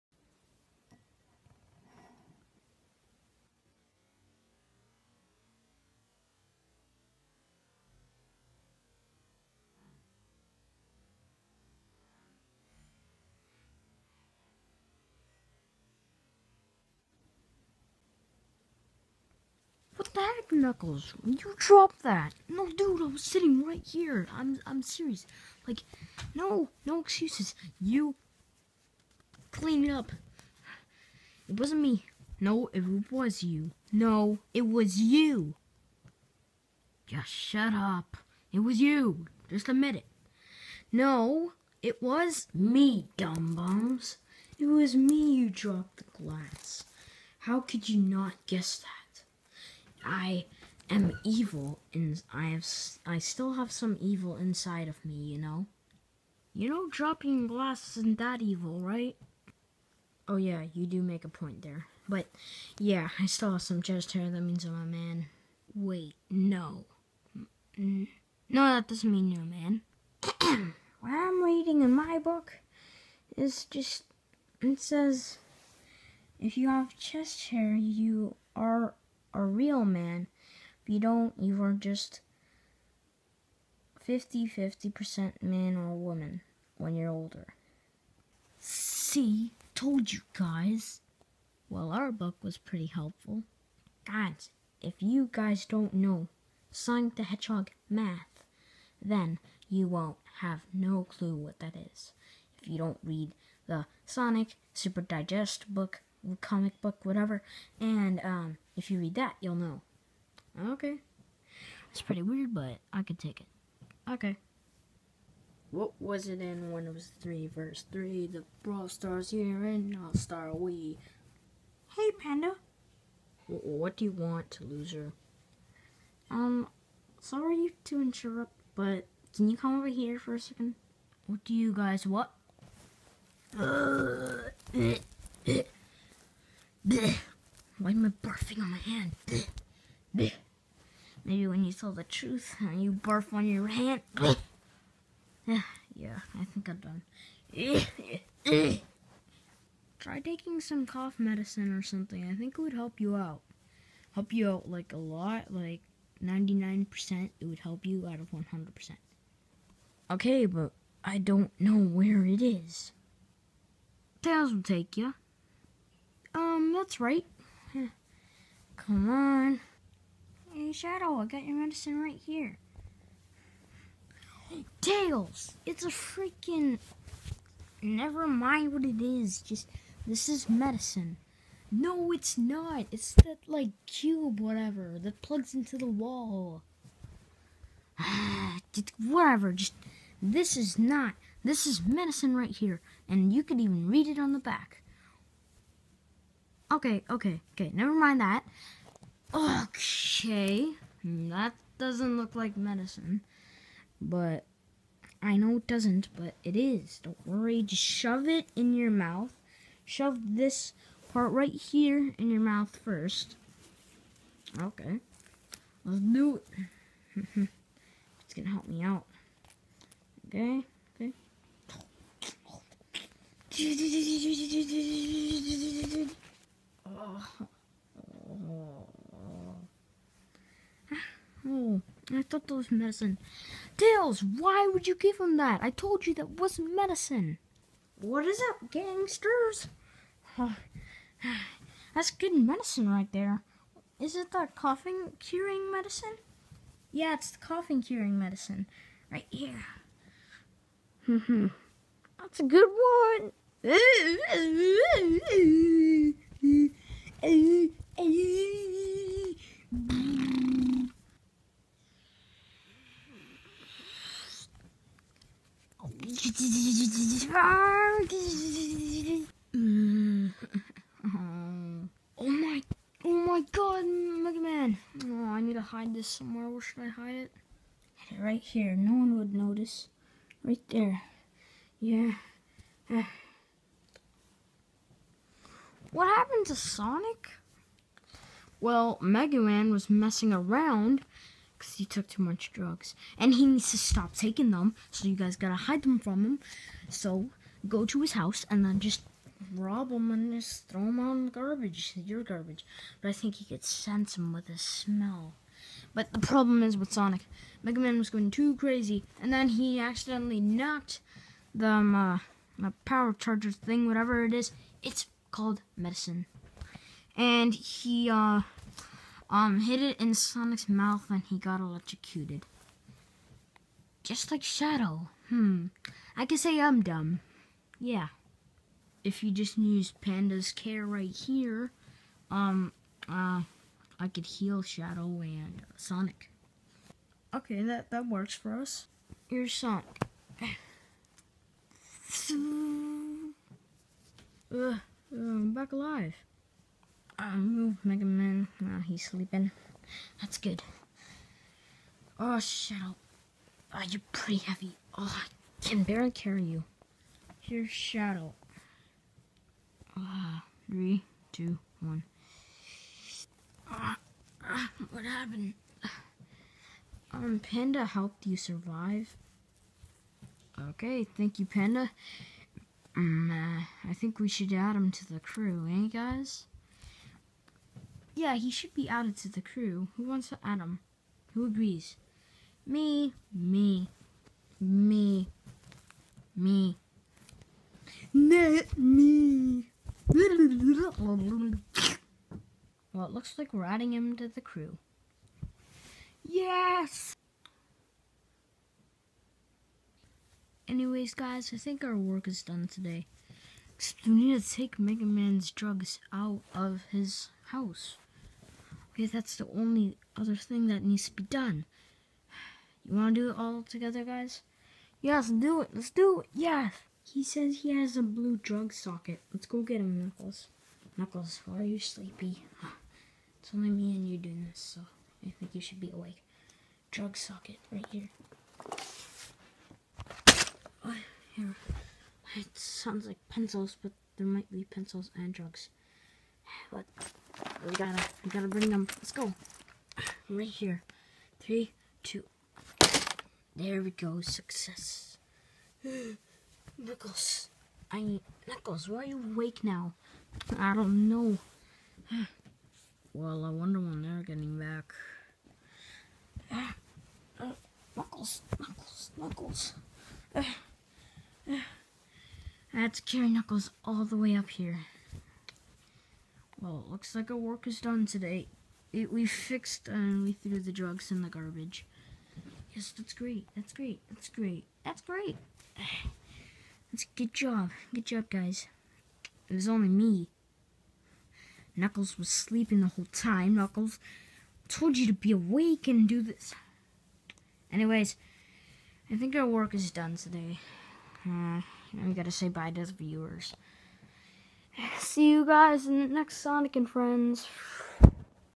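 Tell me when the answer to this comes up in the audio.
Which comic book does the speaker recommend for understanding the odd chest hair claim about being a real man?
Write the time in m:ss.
1:44.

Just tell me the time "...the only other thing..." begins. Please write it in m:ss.
6:49.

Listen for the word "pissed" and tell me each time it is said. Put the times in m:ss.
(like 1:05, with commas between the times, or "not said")
not said.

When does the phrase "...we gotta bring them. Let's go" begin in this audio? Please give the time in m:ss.
7:18.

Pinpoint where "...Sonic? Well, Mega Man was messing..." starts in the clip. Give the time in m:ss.
4:46.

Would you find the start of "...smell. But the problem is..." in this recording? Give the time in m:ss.
5:04.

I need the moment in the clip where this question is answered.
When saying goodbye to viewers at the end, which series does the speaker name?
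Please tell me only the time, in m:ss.
8:16.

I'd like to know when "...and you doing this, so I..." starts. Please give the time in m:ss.
7:03.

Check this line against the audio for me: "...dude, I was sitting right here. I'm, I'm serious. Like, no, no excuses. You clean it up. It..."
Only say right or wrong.
right.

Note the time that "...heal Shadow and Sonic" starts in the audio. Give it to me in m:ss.
5:34.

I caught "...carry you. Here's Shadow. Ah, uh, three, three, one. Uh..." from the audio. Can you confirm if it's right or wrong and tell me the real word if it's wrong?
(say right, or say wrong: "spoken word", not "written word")
wrong: "two", not "three".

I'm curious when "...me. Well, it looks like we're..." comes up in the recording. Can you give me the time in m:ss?
6:28.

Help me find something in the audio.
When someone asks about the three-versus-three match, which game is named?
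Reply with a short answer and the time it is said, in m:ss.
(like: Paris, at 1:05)
Brawl Stars, at 1:58.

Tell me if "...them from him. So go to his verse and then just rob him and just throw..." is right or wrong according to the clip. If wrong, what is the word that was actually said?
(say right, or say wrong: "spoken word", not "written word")
wrong: "house", not "verse".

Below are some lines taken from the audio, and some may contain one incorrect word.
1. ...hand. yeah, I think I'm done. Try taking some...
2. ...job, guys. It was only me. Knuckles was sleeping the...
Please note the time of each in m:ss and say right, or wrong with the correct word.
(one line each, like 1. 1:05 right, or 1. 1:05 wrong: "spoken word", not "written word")
1. 2:23 right
2. 7:58 right.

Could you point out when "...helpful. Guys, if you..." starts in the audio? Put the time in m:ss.
1:32.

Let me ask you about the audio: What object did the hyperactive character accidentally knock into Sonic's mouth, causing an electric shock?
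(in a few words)
Power charger.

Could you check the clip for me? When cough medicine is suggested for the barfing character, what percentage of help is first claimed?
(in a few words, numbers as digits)
99%.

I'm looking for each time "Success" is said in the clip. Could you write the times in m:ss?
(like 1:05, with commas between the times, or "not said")
7:24.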